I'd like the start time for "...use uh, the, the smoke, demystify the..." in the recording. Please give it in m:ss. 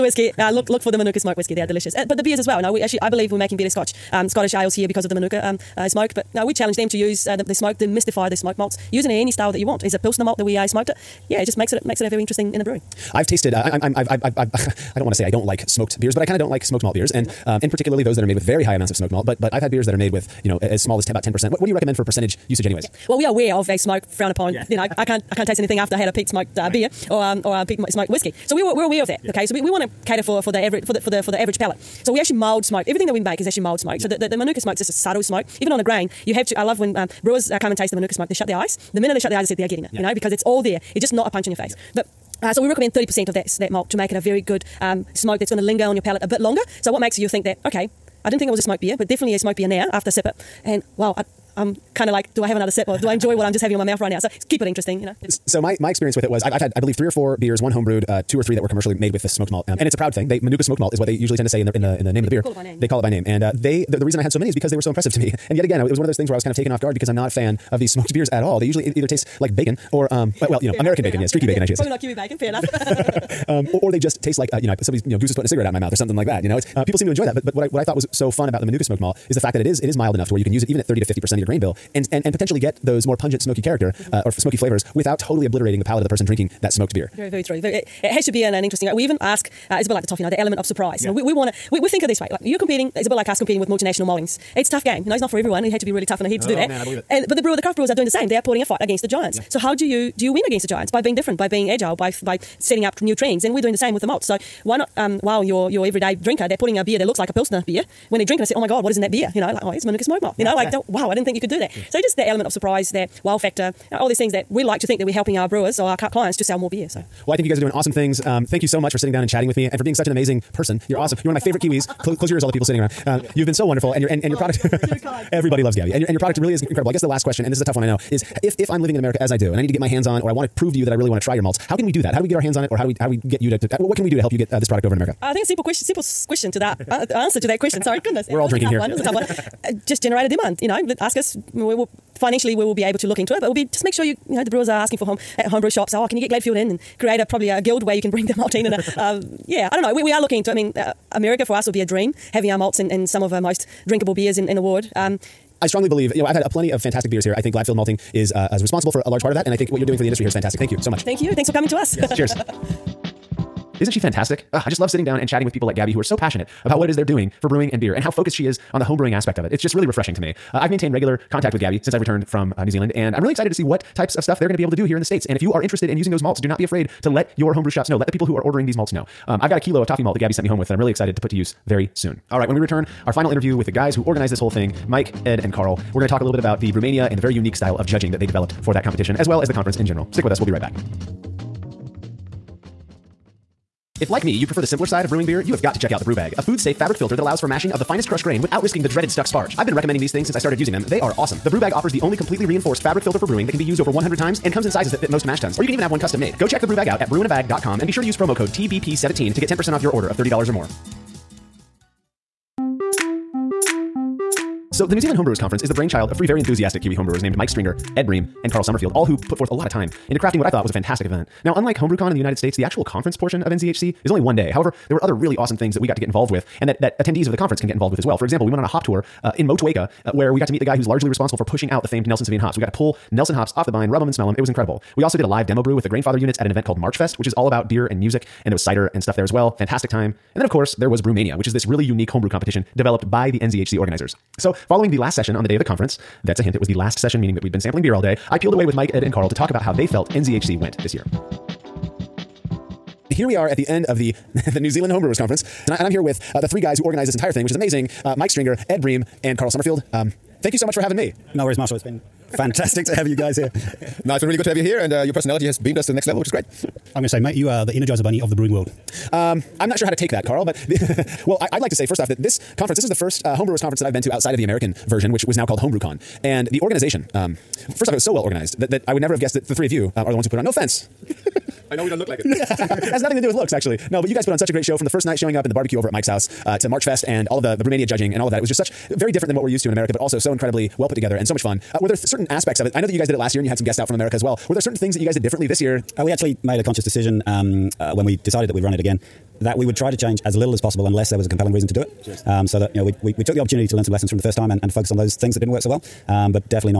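0:06.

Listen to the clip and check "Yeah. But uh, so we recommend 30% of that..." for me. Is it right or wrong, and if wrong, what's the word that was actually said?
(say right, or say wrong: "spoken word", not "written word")
right.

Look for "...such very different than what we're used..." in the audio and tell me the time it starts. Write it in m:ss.
4:48.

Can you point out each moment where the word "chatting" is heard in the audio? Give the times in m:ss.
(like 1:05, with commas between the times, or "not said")
1:59, 2:45.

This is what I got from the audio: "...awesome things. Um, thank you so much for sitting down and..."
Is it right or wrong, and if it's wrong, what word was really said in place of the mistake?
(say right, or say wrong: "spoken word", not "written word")
right.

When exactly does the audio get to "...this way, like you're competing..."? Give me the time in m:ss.
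1:32.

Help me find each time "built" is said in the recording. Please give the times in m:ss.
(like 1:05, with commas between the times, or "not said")
not said.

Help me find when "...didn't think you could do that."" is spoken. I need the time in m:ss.
1:51.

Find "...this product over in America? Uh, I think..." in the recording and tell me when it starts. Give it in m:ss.
2:14.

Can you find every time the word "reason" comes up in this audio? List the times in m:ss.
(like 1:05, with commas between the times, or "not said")
1:04, 5:01.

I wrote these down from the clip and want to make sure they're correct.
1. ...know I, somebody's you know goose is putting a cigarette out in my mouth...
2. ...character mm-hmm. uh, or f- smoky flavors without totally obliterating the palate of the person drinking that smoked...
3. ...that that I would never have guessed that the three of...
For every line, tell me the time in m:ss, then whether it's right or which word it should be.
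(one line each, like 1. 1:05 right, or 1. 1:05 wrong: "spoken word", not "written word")
1. 1:14 right
2. 1:23 right
3. 4:38 right.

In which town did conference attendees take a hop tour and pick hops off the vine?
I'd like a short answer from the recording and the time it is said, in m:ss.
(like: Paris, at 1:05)
Motueka, at 3:49.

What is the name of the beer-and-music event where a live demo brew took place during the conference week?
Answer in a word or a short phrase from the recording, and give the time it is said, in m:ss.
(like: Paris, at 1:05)
Marchfest, at 3:56.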